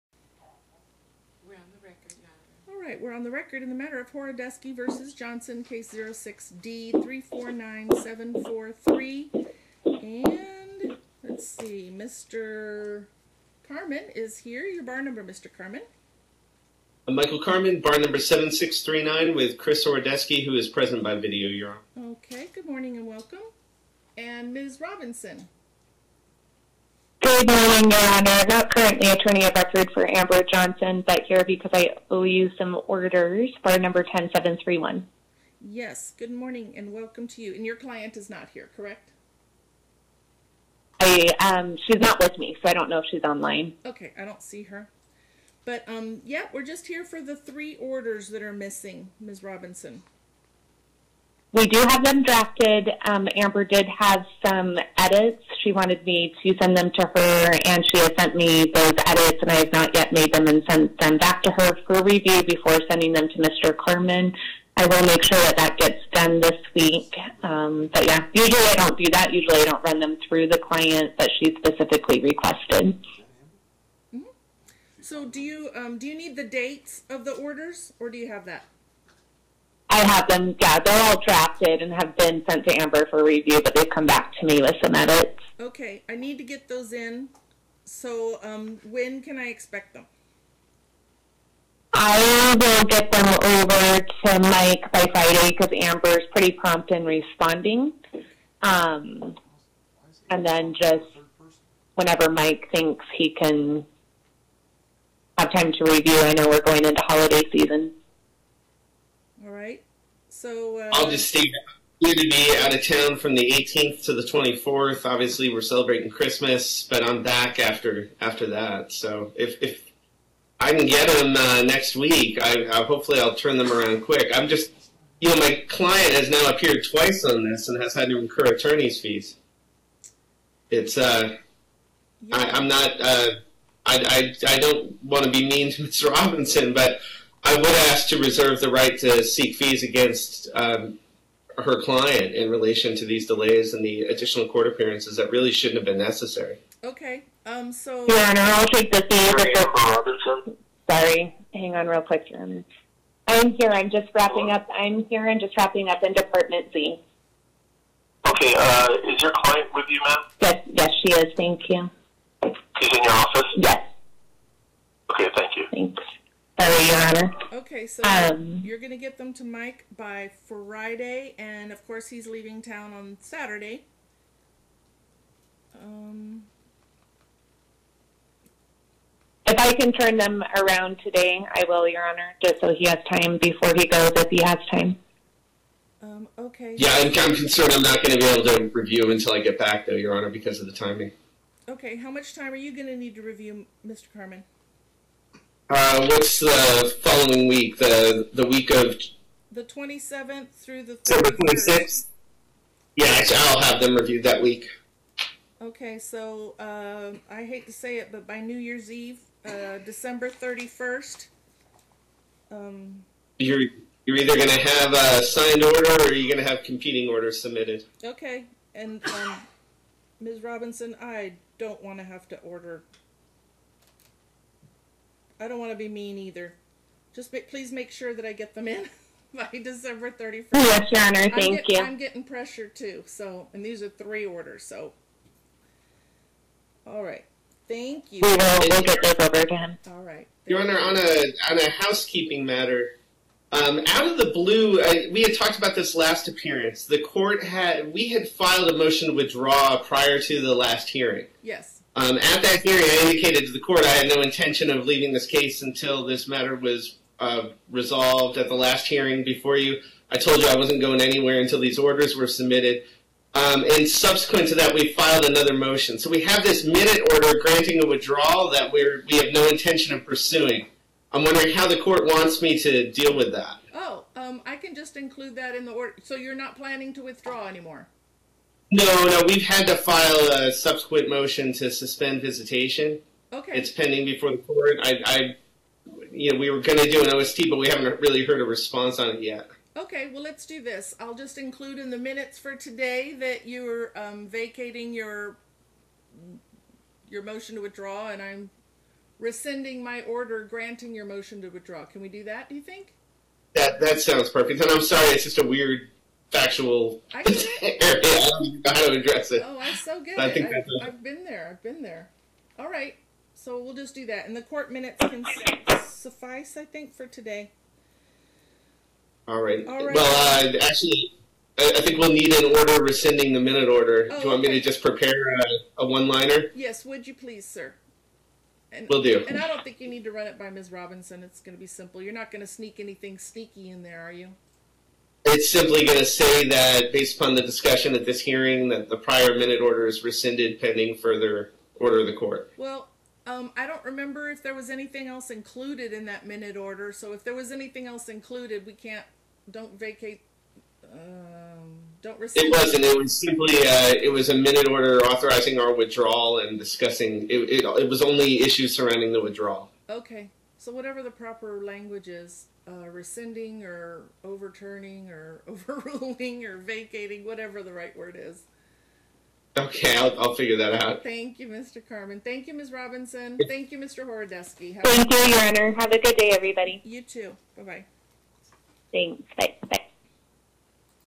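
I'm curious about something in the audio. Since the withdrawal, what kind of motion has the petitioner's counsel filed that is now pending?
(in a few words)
motion to suspend visitation.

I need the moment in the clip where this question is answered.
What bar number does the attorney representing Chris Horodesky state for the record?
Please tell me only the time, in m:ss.
0:18.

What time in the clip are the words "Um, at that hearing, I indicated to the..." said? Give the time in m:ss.
4:11.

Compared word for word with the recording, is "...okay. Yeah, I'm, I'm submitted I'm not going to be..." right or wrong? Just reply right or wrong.
wrong.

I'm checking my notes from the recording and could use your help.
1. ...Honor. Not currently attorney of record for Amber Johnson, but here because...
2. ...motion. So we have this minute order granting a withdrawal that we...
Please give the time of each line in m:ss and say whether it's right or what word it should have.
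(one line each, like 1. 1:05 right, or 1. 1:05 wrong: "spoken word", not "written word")
1. 0:28 right
2. 4:25 right.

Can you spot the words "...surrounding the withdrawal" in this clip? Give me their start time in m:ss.
5:58.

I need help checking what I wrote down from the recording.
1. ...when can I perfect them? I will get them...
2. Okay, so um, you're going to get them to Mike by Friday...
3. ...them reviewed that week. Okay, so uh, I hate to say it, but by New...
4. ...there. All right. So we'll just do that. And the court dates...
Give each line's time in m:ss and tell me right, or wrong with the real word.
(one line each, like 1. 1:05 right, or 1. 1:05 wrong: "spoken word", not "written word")
1. 1:28 wrong: "expect", not "perfect"
2. 2:47 right
3. 3:23 right
4. 5:11 wrong: "minutes", not "dates".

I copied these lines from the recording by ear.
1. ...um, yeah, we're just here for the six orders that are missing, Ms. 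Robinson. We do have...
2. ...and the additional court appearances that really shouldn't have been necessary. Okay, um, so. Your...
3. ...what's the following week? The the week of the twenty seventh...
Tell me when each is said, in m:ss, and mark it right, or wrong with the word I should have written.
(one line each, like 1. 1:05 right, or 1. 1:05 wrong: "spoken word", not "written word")
1. 0:45 wrong: "three", not "six"
2. 2:23 right
3. 3:16 right.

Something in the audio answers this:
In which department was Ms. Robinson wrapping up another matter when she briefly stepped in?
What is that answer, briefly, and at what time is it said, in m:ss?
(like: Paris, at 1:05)
Department Z, at 2:36.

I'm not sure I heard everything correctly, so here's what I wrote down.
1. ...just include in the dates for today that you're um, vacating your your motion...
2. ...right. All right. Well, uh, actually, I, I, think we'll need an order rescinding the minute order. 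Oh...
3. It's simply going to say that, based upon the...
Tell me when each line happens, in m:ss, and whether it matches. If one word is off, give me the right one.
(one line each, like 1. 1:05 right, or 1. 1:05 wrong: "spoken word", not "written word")
1. 4:51 wrong: "minutes", not "dates"
2. 5:19 right
3. 5:35 right.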